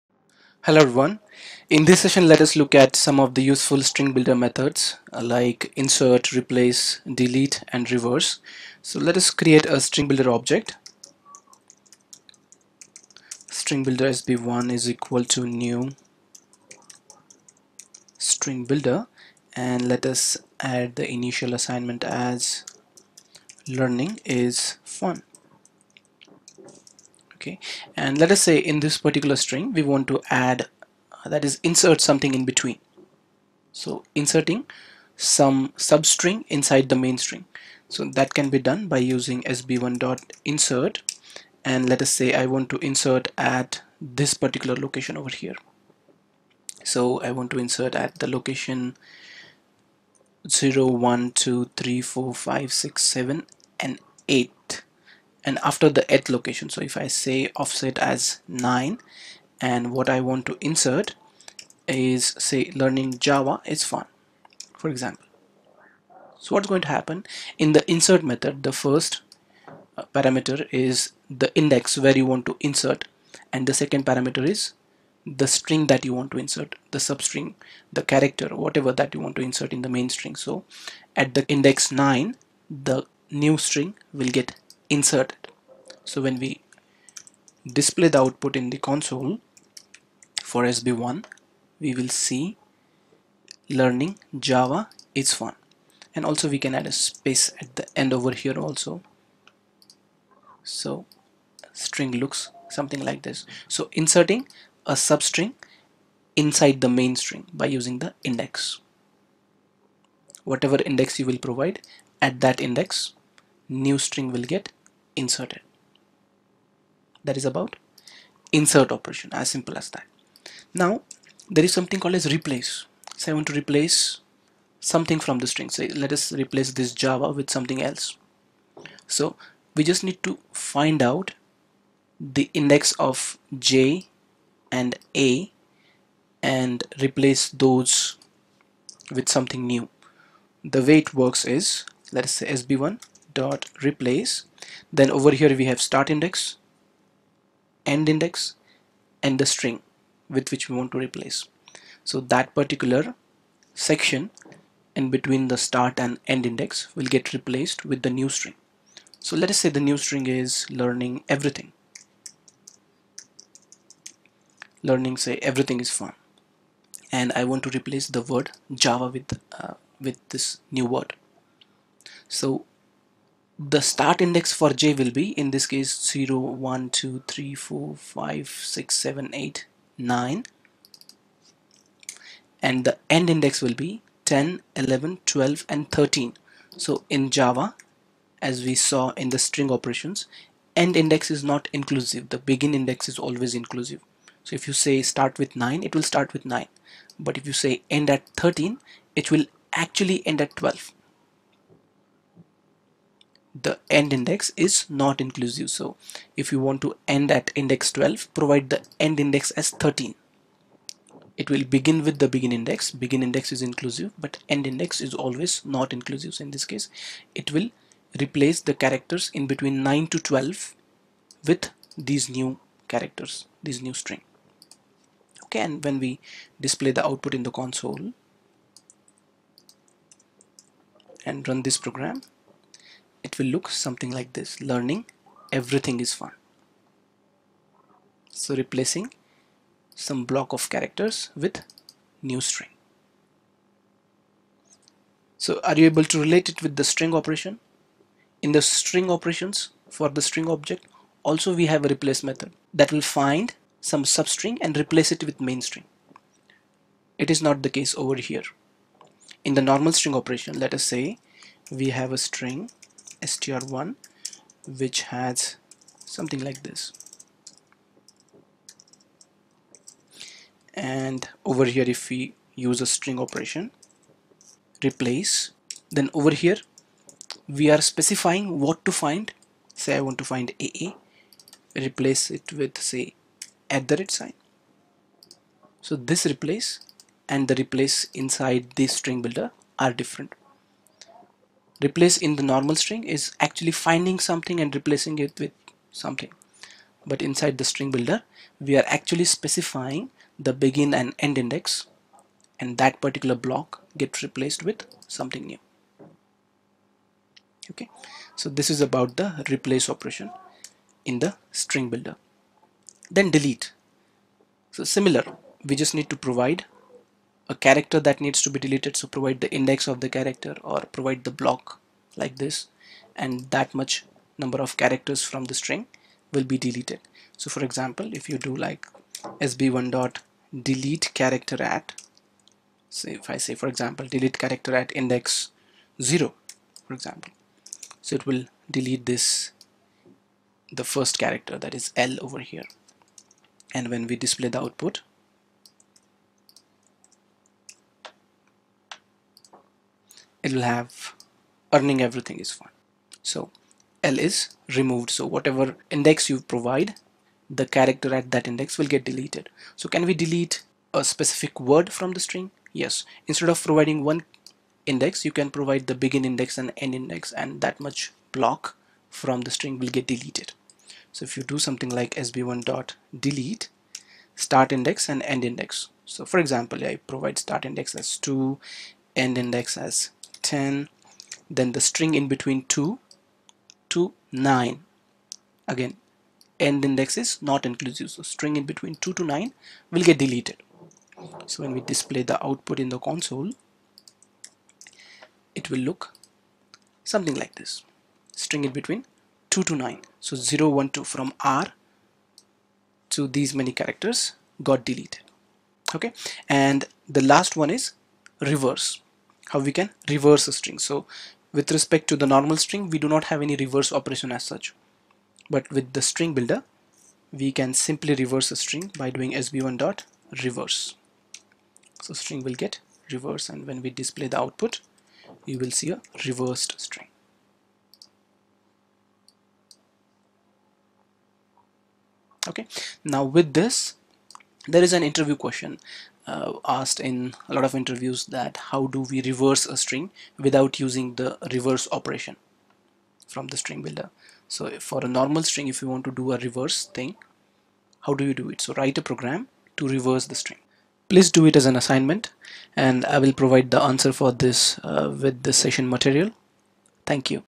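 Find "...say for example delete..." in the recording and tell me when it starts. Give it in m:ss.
5:33.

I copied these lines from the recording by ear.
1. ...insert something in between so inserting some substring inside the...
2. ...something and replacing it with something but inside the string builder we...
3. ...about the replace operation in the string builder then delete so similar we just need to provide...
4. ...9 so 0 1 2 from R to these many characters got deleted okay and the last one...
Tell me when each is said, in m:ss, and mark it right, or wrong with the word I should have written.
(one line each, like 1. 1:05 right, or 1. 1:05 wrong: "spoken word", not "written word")
1. 0:31 right
2. 4:54 right
3. 5:08 right
4. 6:39 right.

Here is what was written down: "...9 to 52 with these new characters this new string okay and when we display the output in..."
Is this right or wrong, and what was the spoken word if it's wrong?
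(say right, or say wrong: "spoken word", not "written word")
wrong: "12", not "52".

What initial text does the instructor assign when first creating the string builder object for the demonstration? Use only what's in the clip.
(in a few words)
learning is fun.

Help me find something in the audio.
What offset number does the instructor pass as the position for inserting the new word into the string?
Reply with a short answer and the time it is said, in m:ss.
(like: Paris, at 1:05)
9, at 0:57.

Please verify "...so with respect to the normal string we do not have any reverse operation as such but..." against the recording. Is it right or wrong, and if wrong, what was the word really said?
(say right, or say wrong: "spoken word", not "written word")
right.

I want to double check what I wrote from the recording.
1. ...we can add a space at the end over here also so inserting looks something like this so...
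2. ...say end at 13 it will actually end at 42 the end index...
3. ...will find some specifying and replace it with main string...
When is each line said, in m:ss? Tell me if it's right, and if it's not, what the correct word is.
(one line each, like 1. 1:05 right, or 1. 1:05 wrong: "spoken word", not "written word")
1. 1:36 wrong: "string", not "inserting"
2. 3:17 wrong: "12", not "42"
3. 4:12 wrong: "substring", not "specifying".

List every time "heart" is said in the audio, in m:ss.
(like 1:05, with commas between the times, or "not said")
not said.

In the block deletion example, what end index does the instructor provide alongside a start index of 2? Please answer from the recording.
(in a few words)
10.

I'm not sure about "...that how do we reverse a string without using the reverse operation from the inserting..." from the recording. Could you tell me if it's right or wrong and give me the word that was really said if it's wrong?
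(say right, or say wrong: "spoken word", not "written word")
wrong: "string", not "inserting".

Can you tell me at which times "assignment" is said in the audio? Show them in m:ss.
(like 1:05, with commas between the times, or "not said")
0:21, 7:31.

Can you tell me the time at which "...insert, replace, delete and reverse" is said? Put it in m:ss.
0:05.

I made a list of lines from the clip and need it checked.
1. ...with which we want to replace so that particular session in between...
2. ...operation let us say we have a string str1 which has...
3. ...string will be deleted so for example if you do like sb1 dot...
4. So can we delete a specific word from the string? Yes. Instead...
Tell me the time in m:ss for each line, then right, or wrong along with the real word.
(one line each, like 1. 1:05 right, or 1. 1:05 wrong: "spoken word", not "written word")
1. 2:30 wrong: "section", not "session"
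2. 4:20 right
3. 5:25 right
4. 5:59 right.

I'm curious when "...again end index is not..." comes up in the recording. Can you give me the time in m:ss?
6:25.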